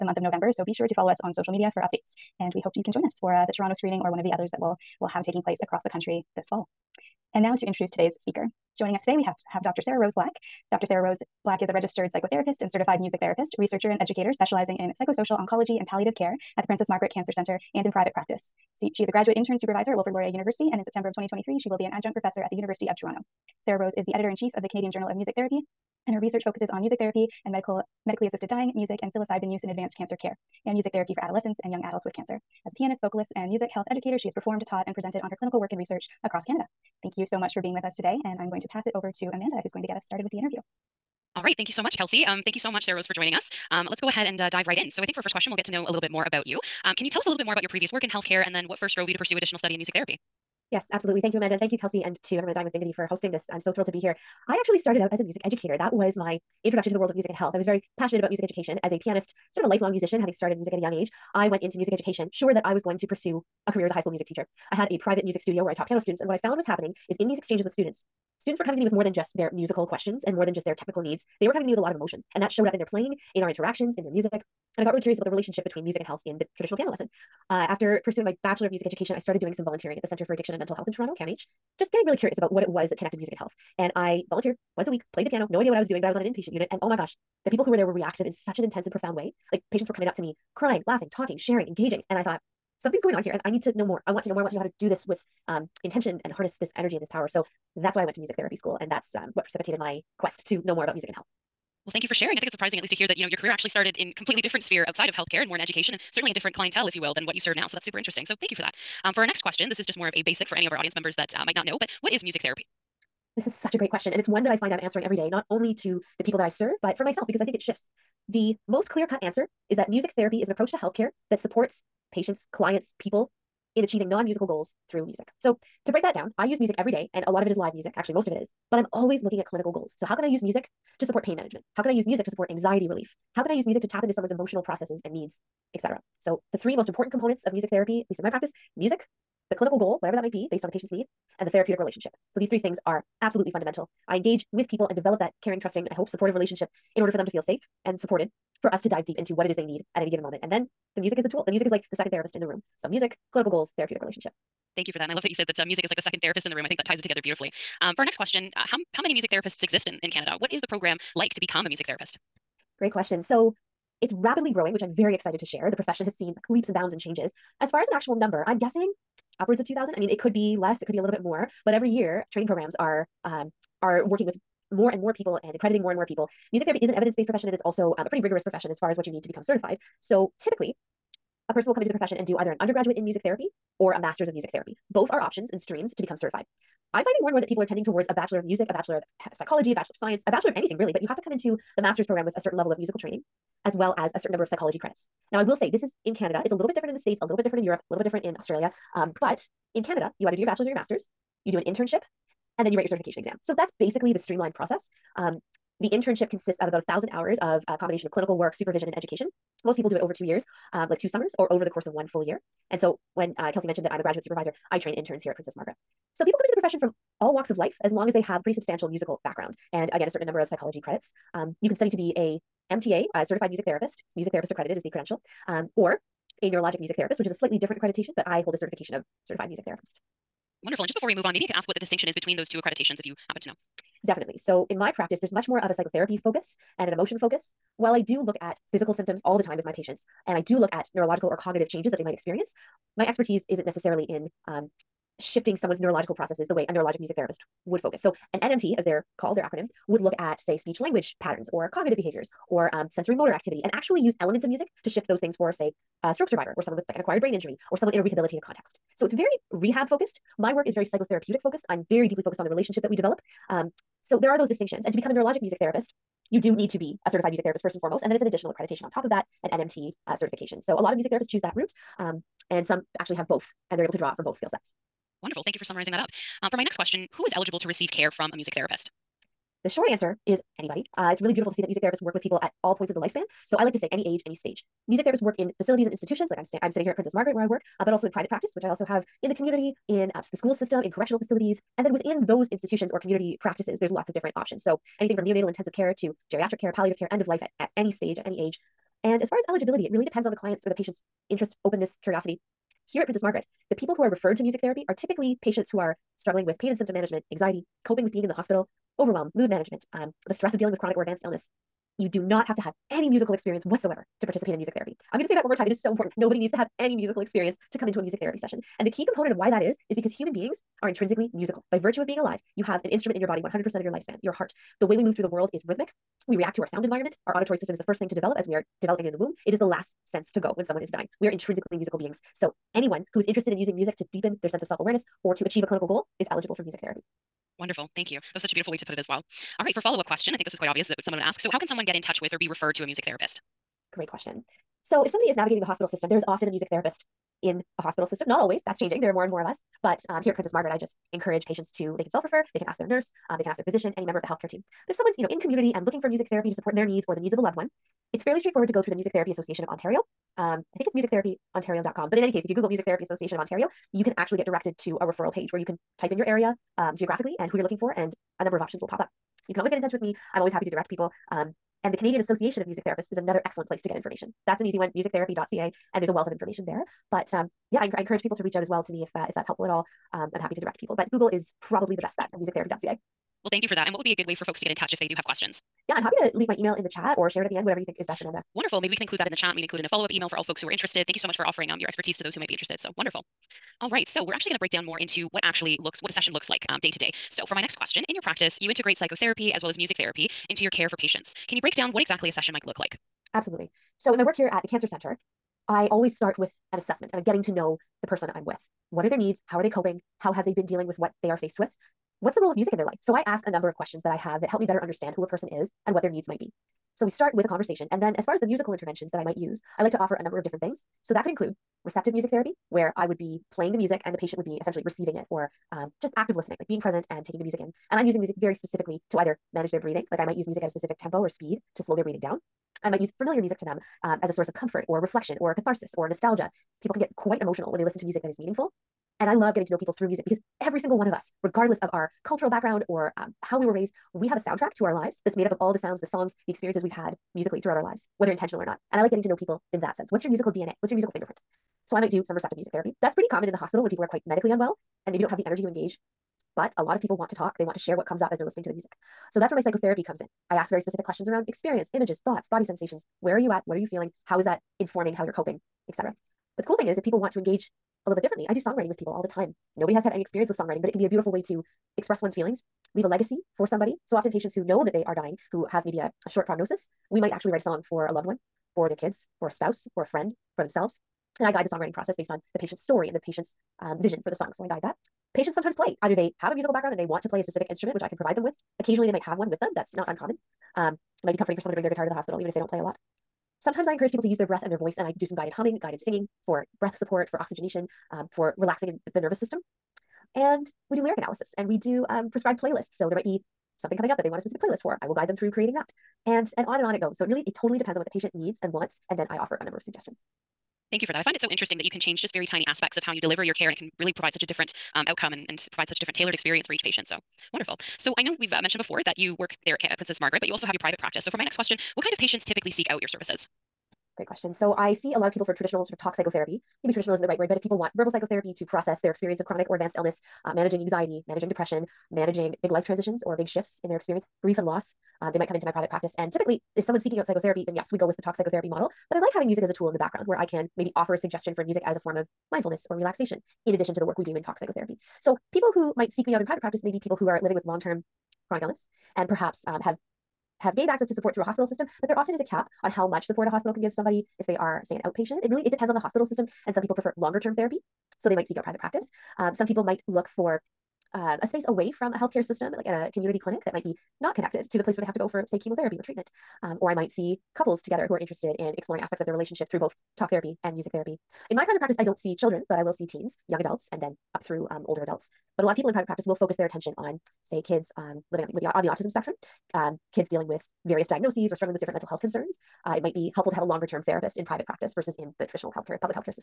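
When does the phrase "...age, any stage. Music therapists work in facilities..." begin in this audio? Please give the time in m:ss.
4:44.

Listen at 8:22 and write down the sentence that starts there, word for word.
So there might be something coming up that they want a specific playlist for.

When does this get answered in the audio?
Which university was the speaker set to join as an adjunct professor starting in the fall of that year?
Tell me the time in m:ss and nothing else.
0:22.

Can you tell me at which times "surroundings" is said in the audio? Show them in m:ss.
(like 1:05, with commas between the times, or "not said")
not said.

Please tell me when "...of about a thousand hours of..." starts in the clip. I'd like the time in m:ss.
3:26.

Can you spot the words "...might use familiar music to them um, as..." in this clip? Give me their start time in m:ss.
7:12.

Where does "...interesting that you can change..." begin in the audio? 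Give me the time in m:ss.
8:31.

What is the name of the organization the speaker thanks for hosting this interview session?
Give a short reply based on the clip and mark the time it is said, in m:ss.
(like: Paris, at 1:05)
Dying with Dignity, at 0:52.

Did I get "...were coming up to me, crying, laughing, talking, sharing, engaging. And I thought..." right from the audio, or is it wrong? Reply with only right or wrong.
right.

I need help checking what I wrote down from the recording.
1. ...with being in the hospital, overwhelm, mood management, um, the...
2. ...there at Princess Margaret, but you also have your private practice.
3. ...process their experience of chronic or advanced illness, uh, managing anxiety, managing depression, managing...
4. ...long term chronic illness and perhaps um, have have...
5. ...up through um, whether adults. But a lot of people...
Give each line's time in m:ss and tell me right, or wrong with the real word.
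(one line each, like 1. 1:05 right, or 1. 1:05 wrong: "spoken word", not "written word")
1. 5:08 right
2. 8:39 right
3. 8:48 right
4. 9:07 right
5. 9:34 wrong: "older", not "whether".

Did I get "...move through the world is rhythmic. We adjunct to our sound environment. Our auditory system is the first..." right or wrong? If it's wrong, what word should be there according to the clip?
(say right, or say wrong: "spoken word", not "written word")
wrong: "react", not "adjunct".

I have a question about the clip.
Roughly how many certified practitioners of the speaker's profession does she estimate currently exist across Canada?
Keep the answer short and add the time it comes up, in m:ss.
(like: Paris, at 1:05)
2000, at 2:49.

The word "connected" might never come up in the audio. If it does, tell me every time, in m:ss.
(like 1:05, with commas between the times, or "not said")
1:22, 9:24.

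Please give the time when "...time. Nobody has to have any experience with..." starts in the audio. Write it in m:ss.
7:49.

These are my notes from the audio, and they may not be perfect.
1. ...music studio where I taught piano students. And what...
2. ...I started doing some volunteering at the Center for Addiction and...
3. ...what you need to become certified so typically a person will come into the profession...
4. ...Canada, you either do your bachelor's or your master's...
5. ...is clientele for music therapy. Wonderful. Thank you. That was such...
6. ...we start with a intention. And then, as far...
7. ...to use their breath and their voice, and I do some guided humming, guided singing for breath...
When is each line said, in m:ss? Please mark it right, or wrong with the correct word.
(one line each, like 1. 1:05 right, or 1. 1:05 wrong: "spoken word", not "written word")
1. 1:05 right
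2. 1:19 right
3. 2:58 right
4. 3:19 right
5. 5:36 wrong: "eligible", not "clientele"
6. 6:57 wrong: "conversation", not "intention"
7. 8:14 right.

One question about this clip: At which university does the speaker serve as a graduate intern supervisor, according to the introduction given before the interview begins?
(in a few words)
Wilfrid Laurier University.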